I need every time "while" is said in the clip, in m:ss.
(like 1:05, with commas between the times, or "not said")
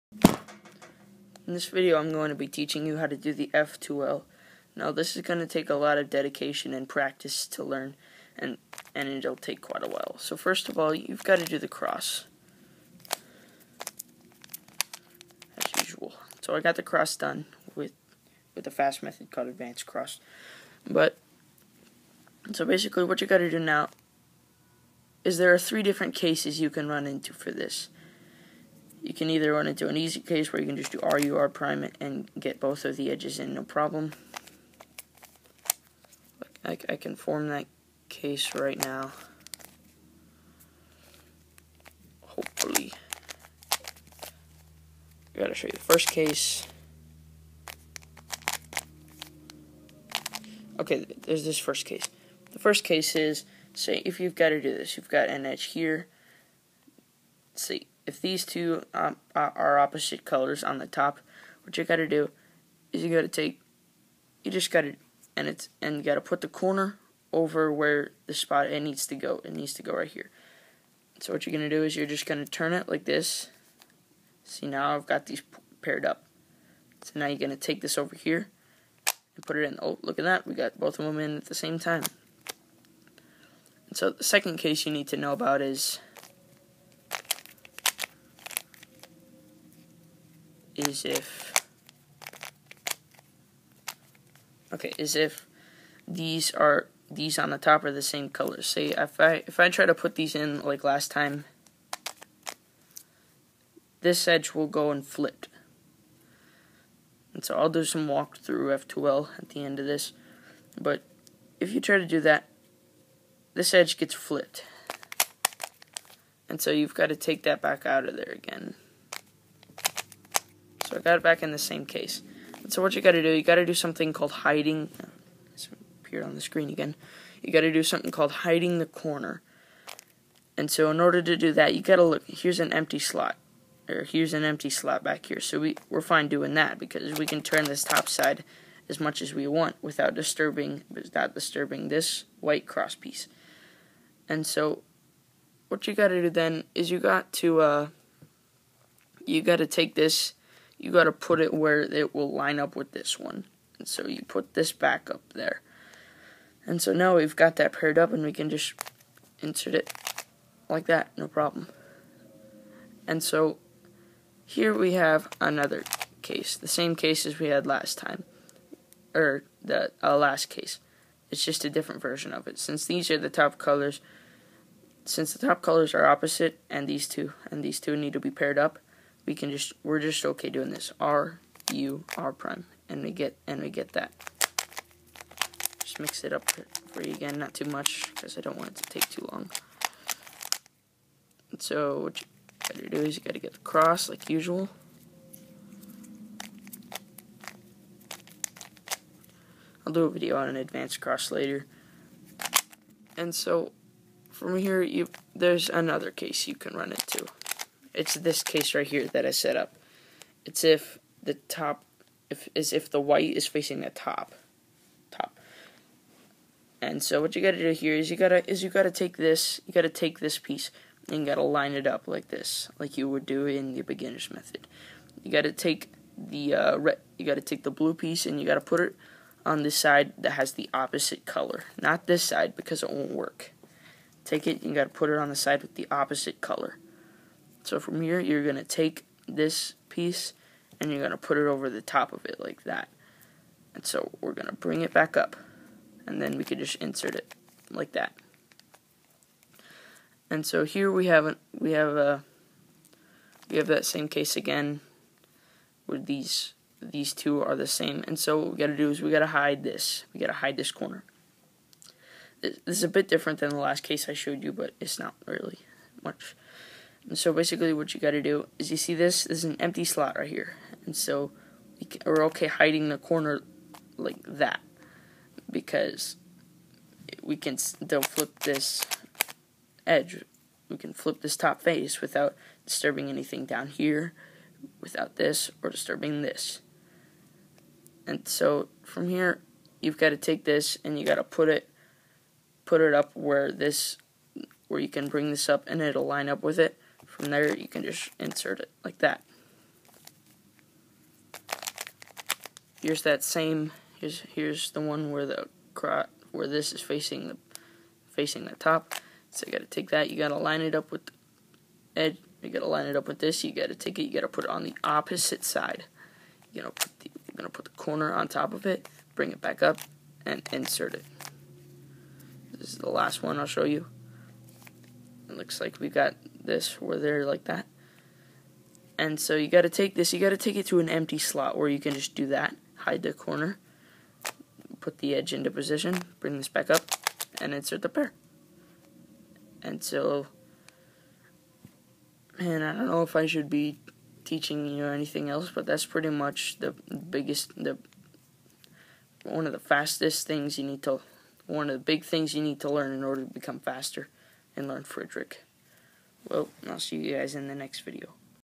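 0:09.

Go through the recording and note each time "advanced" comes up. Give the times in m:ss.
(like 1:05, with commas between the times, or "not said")
0:19, 3:20.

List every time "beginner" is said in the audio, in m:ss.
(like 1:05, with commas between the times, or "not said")
3:43.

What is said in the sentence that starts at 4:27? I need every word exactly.
And so basically what you got to do is you see this, this is an empty slot right here.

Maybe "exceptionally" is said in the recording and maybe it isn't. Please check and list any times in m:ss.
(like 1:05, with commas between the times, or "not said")
not said.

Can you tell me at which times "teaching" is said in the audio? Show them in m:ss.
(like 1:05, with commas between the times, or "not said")
0:02, 5:44.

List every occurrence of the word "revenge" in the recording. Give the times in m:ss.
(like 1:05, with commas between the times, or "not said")
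not said.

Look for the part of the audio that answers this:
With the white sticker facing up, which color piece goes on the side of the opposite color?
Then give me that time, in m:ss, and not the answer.
3:47.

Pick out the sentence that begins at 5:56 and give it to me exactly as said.
Well, I'll see you guys in the next video.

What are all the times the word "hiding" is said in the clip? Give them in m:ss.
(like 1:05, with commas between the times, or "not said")
2:04, 2:08, 4:32.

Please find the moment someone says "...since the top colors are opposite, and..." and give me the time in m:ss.
2:55.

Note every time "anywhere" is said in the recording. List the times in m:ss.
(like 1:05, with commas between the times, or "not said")
not said.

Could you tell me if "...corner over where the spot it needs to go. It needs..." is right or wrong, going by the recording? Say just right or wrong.
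right.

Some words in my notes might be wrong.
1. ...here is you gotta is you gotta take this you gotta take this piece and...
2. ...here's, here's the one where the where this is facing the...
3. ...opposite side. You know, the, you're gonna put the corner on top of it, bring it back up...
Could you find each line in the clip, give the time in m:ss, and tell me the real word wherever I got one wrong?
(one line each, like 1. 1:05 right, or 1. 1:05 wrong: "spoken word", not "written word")
1. 3:37 right
2. 5:03 right
3. 5:14 right.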